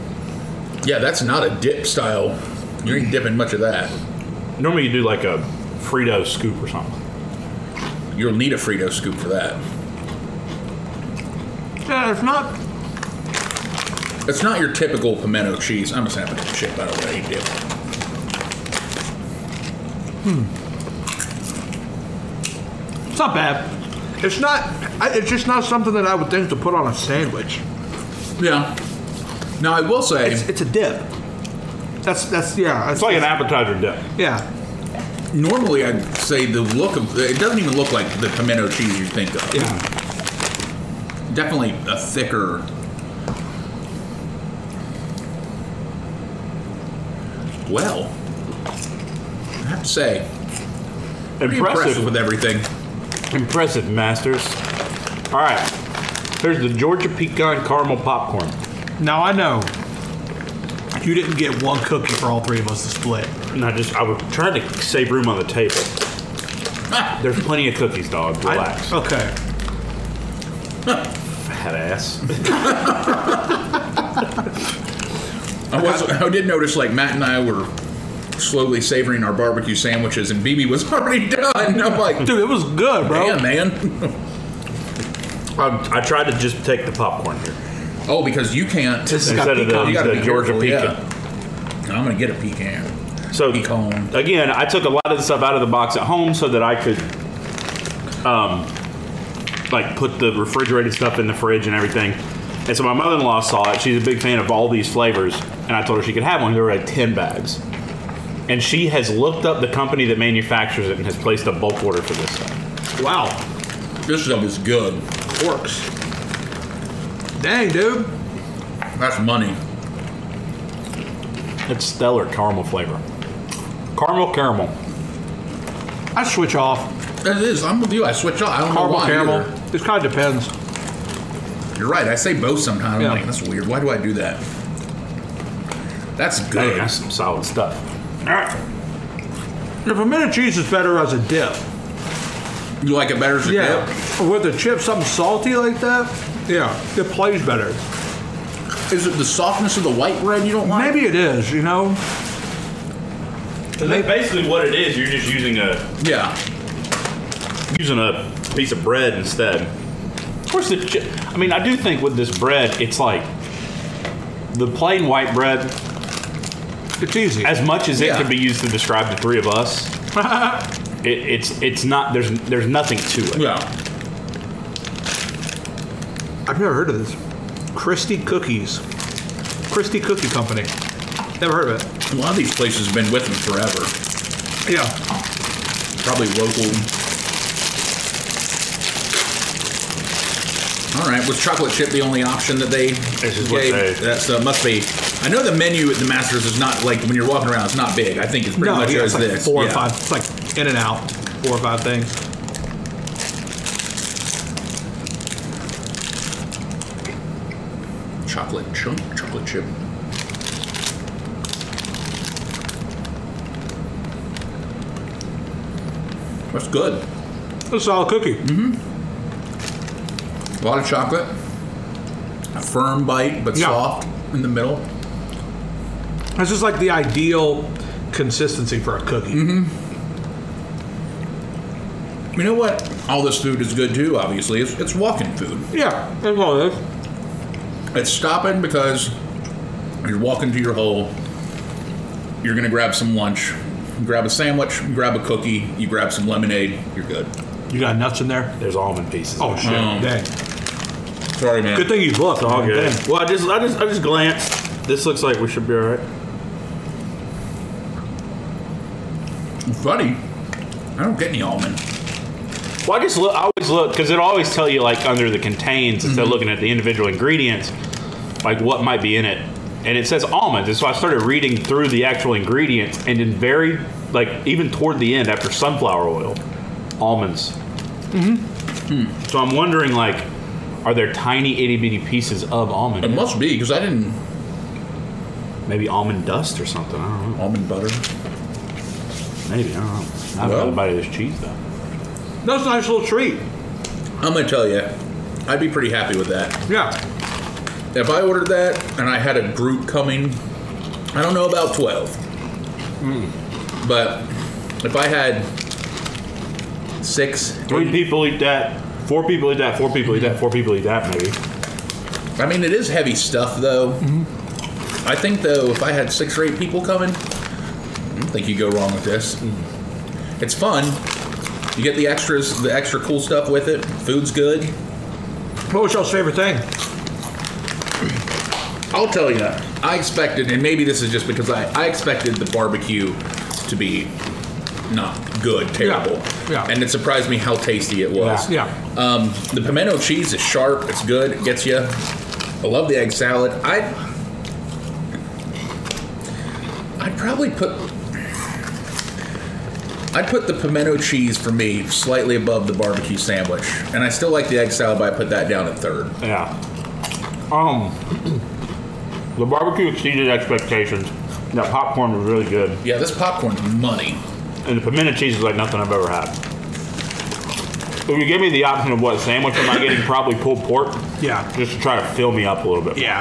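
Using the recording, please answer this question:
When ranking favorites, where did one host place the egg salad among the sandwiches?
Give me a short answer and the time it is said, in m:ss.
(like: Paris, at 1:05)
Third, at 5:55.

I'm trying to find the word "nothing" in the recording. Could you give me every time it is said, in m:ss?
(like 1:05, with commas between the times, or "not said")
2:52, 6:05.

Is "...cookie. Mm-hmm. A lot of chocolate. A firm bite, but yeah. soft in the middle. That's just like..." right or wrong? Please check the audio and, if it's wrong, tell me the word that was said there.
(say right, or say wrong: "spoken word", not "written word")
right.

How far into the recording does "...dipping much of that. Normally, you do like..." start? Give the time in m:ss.
0:03.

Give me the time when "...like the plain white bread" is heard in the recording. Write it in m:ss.
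2:42.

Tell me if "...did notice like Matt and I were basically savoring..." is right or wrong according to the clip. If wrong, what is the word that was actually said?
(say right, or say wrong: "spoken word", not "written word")
wrong: "slowly", not "basically".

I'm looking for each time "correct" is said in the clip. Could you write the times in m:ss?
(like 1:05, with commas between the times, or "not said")
not said.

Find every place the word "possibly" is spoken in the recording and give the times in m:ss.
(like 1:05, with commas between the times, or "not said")
not said.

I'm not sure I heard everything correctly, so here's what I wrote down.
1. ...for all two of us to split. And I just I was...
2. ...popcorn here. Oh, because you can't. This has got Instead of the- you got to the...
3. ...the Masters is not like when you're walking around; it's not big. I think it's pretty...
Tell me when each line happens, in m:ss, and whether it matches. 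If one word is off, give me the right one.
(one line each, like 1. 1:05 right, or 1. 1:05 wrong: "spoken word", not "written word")
1. 1:02 wrong: "three", not "two"
2. 1:26 right
3. 3:15 right.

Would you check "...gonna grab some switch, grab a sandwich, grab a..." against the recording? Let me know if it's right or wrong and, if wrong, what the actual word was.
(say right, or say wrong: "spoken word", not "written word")
wrong: "lunch", not "switch".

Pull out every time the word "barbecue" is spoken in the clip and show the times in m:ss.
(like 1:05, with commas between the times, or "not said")
1:19, 5:32, 5:52, 5:59.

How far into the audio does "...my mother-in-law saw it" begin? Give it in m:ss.
1:42.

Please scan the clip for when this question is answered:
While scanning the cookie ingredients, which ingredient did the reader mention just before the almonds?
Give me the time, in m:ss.
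4:35.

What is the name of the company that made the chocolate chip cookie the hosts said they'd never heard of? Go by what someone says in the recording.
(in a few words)
Christie Cookie Company.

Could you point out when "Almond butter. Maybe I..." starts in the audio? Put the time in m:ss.
4:47.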